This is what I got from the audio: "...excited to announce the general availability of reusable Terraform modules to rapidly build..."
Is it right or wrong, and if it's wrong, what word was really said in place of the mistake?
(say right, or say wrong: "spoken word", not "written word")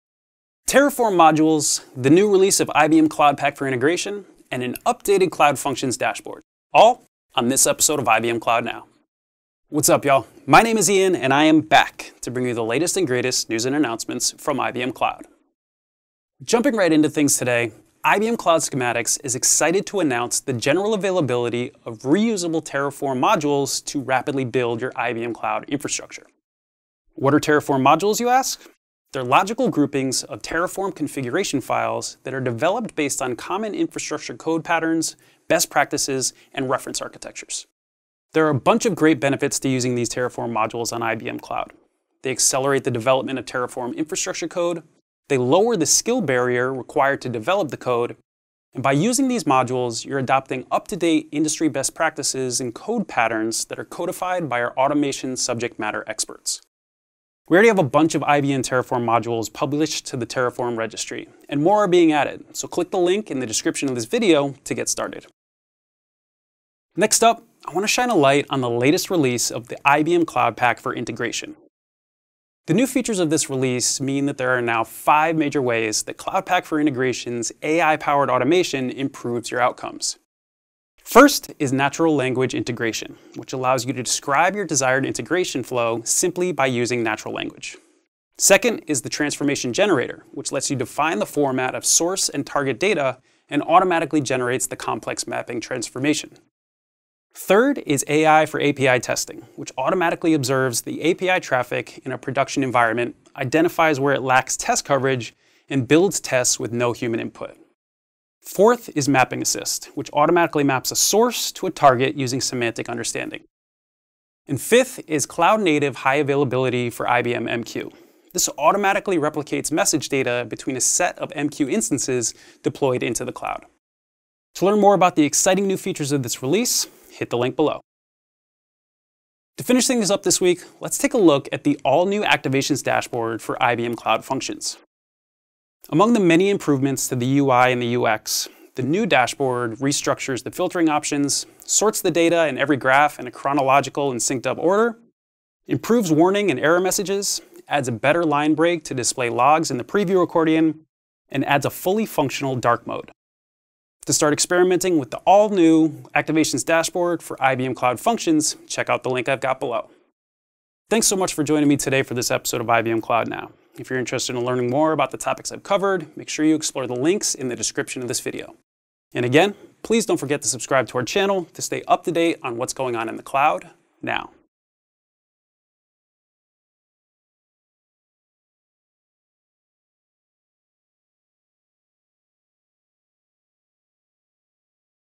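right.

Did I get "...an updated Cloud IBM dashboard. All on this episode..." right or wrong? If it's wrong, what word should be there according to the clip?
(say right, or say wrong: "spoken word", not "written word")
wrong: "Functions", not "IBM".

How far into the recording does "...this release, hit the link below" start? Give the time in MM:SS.
02:06.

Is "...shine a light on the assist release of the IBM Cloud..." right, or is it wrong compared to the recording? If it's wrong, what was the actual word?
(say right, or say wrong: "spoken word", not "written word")
wrong: "latest", not "assist".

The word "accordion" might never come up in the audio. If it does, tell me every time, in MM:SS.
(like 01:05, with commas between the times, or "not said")
02:30.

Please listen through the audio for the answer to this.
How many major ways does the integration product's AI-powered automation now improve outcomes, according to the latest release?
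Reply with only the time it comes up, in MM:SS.
01:14.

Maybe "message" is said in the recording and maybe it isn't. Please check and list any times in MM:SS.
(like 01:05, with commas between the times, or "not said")
01:59, 02:26.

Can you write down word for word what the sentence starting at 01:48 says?
Fourth is mapping assist, which automatically maps a source to a target using semantic understanding.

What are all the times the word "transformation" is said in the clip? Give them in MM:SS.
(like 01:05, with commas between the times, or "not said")
01:29, 01:35.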